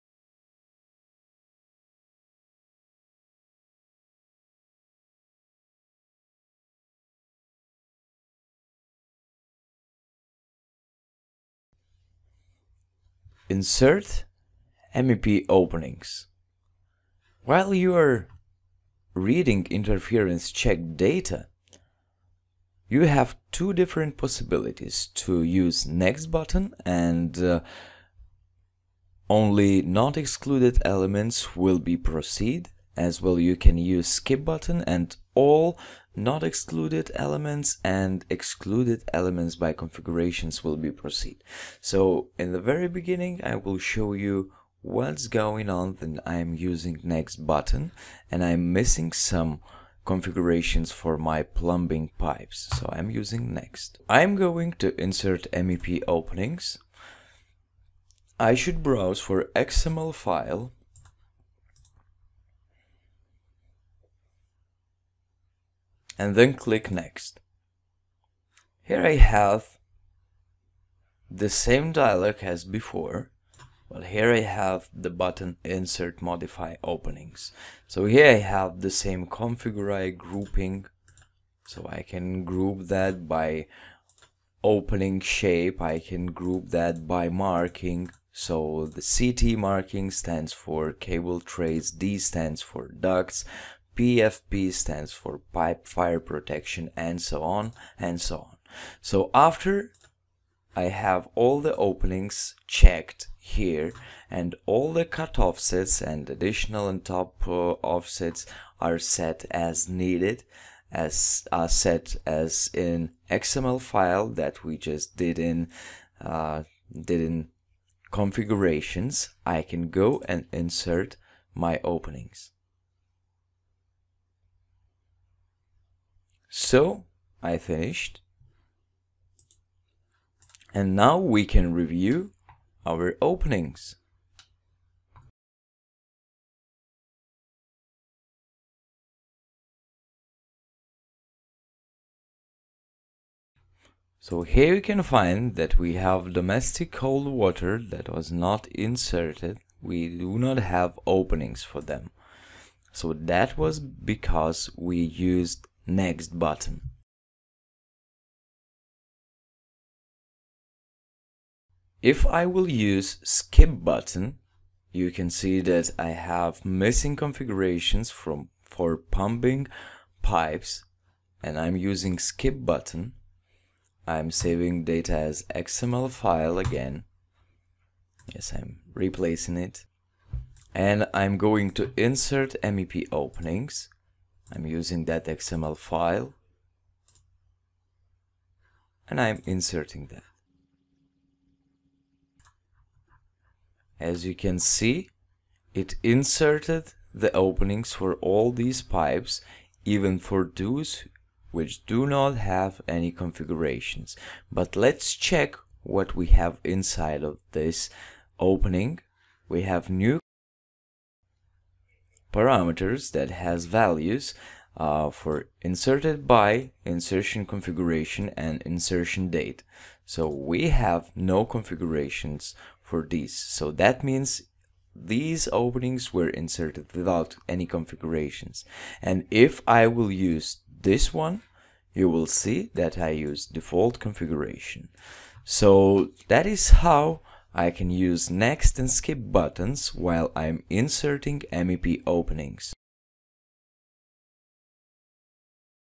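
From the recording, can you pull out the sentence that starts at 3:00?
And I'm going to insert MEP openings I'm using that XML file and I'm inserting that.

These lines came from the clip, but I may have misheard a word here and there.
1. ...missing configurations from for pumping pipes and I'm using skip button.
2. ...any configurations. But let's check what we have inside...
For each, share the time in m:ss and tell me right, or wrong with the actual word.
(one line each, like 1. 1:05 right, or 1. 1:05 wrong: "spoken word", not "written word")
1. 2:46 right
2. 3:22 right.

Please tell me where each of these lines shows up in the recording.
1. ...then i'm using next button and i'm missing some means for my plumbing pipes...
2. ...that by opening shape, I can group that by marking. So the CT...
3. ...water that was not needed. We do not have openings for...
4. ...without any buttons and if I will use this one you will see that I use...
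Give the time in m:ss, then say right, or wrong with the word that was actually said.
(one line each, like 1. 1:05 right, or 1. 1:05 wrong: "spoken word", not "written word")
1. 0:46 wrong: "configurations", not "means"
2. 1:22 right
3. 2:27 wrong: "inserted", not "needed"
4. 3:46 wrong: "configurations", not "buttons".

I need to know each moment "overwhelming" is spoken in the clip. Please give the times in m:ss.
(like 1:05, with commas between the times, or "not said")
not said.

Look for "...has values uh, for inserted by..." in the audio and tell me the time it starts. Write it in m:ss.
3:33.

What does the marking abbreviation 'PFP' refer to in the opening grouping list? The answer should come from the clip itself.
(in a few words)
pipe fire protection.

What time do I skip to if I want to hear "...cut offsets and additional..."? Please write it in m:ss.
1:45.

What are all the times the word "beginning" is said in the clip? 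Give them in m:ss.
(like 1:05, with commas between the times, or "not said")
0:42.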